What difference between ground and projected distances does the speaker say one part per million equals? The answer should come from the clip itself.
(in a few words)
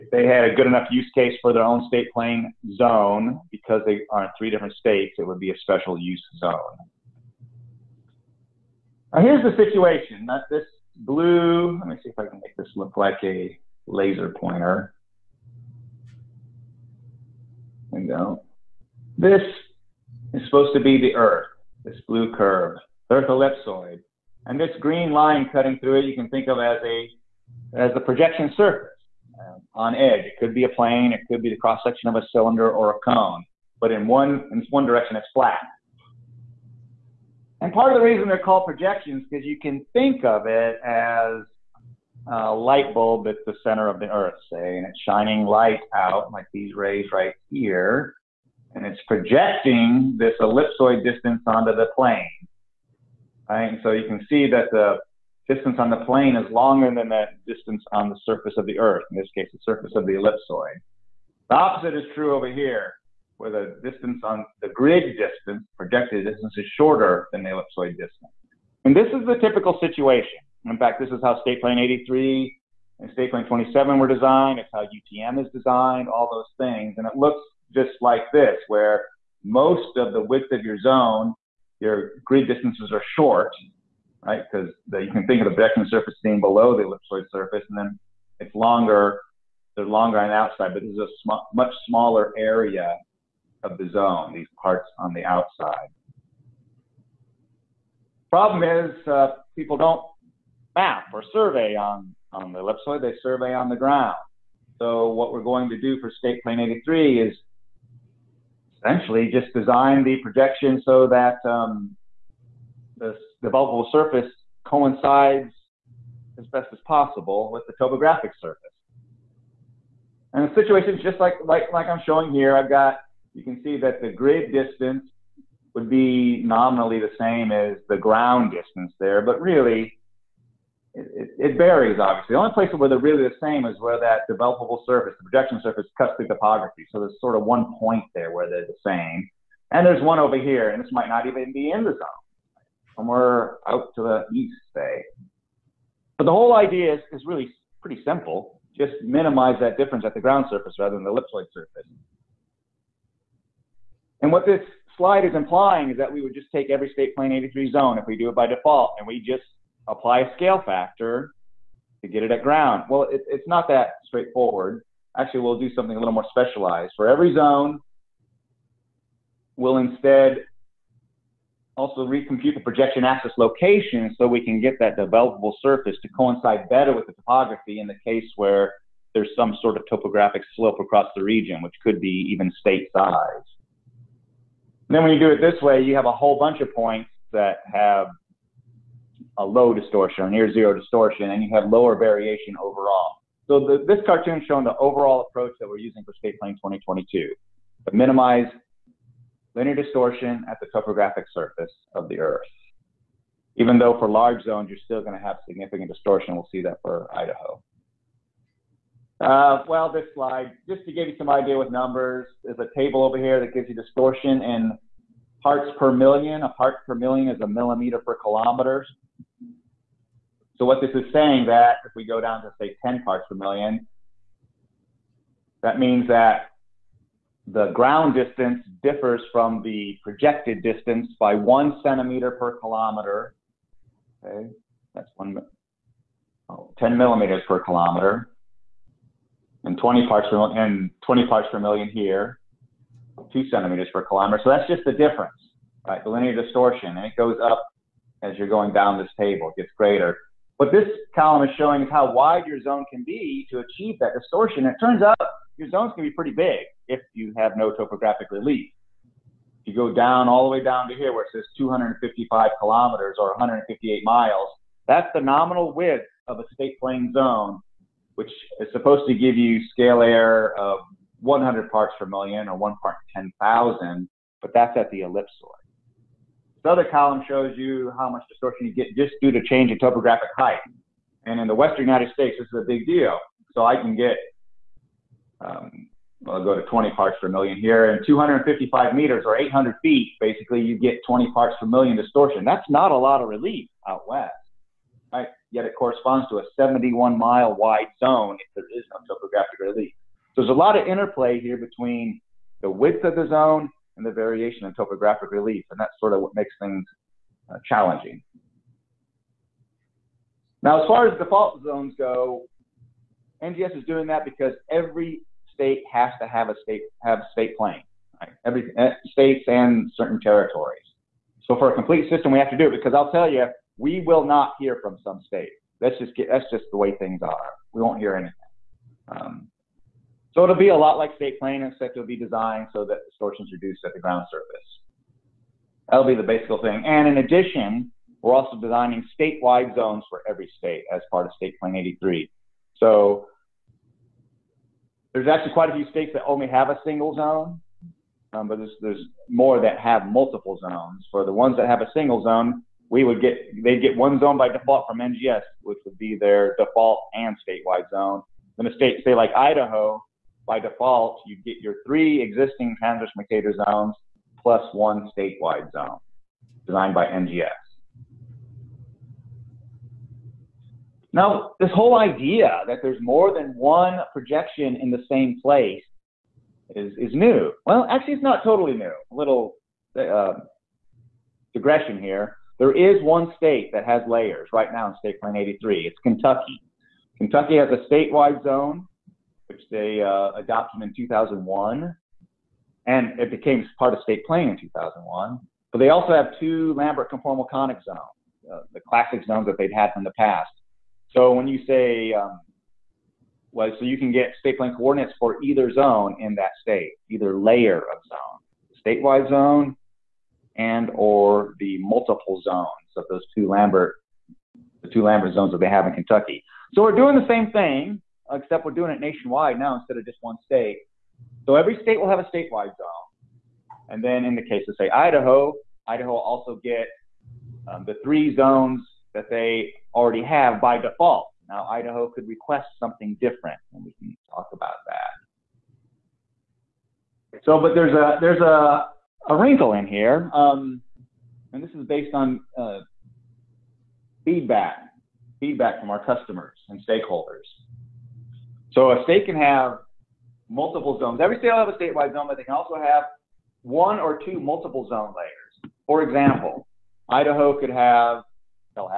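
a millimeter per kilometer.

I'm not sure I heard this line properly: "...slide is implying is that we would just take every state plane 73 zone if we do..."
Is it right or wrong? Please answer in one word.
wrong.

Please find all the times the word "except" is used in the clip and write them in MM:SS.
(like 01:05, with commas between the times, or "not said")
05:31, 06:58.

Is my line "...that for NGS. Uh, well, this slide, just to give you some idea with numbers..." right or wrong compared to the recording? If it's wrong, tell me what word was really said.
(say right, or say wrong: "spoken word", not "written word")
wrong: "Idaho", not "NGS".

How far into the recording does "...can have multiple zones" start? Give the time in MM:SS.
07:29.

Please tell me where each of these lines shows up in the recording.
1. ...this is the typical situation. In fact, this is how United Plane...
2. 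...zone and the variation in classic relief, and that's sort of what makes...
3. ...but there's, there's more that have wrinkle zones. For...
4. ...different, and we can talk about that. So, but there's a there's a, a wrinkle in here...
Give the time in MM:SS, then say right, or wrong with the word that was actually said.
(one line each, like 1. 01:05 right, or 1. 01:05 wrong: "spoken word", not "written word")
1. 01:08 wrong: "State", not "United"
2. 05:03 wrong: "topographic", not "classic"
3. 05:48 wrong: "multiple", not "wrinkle"
4. 07:13 right.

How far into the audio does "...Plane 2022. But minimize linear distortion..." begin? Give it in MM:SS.
03:16.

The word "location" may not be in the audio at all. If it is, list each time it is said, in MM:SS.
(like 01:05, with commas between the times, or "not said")
02:53.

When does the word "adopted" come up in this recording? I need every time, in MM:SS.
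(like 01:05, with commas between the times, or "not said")
06:30.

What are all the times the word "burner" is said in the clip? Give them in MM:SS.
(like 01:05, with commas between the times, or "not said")
not said.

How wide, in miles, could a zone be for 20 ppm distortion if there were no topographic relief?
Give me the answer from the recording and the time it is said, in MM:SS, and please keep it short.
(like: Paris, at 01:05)
71 miles, at 04:56.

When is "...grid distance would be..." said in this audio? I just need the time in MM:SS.
02:04.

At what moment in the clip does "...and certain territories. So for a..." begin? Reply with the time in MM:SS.
05:19.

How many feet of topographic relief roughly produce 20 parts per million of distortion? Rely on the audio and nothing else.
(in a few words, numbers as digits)
800 feet.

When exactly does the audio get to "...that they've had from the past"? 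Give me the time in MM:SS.
06:39.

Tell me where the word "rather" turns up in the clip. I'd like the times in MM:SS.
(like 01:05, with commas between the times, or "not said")
02:30.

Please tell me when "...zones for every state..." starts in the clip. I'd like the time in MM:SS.
05:39.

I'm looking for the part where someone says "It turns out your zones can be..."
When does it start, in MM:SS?
04:14.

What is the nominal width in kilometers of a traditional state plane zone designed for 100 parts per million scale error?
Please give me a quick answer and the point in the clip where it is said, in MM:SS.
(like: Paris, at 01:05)
255 kilometers, at 04:21.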